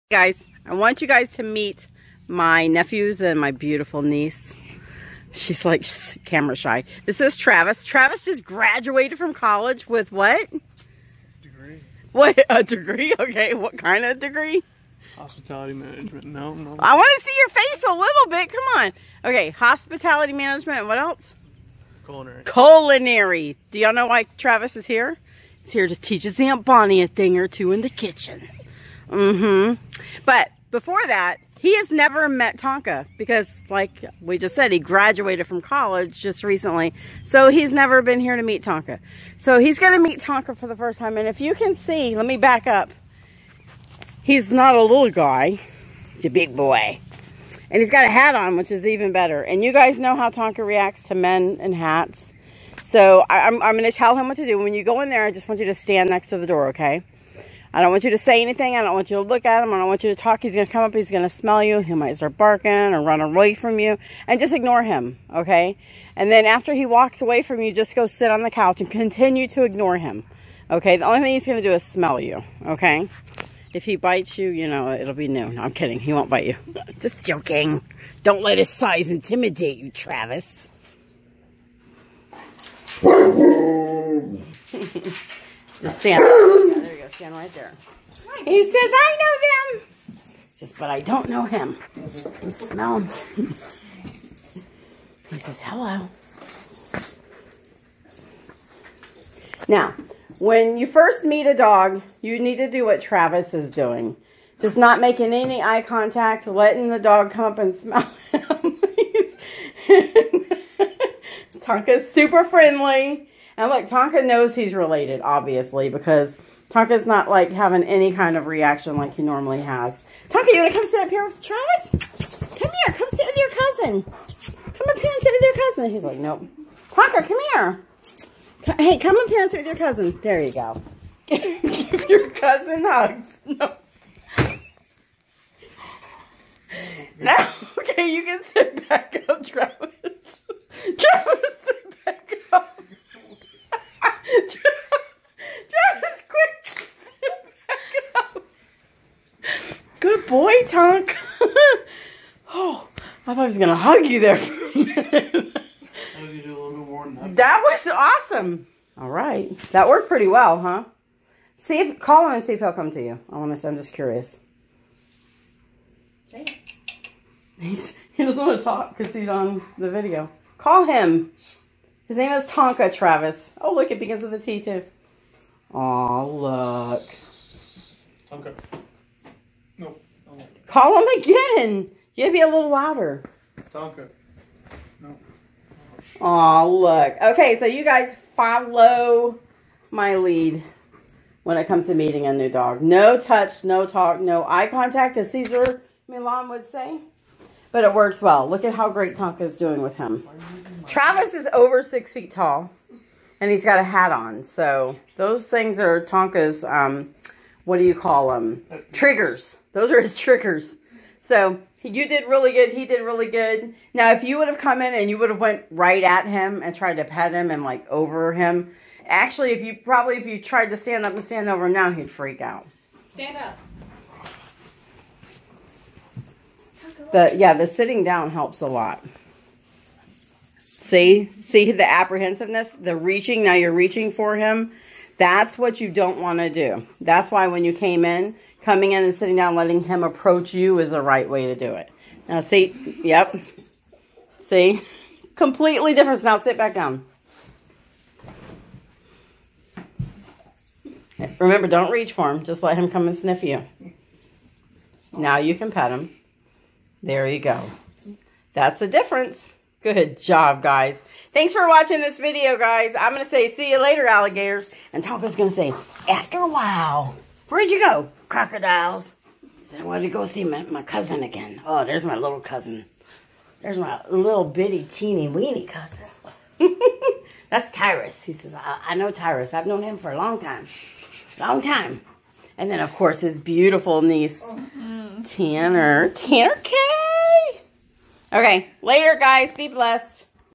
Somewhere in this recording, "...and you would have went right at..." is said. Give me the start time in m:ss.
3:34.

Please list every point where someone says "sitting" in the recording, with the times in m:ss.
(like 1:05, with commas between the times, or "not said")
3:47, 3:59.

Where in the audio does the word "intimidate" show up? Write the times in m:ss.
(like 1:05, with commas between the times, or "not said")
1:19.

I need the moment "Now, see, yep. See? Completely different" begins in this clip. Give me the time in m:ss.
4:02.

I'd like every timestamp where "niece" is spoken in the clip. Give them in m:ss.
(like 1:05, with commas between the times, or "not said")
0:04, 4:44.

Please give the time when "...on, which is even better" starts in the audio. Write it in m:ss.
0:48.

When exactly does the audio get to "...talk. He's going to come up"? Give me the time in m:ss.
1:00.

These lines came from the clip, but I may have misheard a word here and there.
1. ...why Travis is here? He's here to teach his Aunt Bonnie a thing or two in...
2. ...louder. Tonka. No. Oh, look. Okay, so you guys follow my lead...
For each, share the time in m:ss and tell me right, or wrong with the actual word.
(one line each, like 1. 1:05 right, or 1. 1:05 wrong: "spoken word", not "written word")
1. 0:24 right
2. 3:02 right.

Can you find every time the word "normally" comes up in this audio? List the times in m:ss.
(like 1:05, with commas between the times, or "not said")
1:59.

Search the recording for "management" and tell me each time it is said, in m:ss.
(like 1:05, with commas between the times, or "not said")
0:15, 0:20.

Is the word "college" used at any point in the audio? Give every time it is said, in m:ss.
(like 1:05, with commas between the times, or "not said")
0:09, 0:35.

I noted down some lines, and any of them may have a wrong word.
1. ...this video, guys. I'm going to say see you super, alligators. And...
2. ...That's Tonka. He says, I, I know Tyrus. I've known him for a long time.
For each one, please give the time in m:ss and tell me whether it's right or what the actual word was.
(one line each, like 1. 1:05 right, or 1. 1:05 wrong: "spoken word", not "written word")
1. 4:22 wrong: "later", not "super"
2. 4:37 wrong: "Tyrus", not "Tonka".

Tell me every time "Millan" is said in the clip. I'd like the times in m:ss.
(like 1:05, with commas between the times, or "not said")
3:16.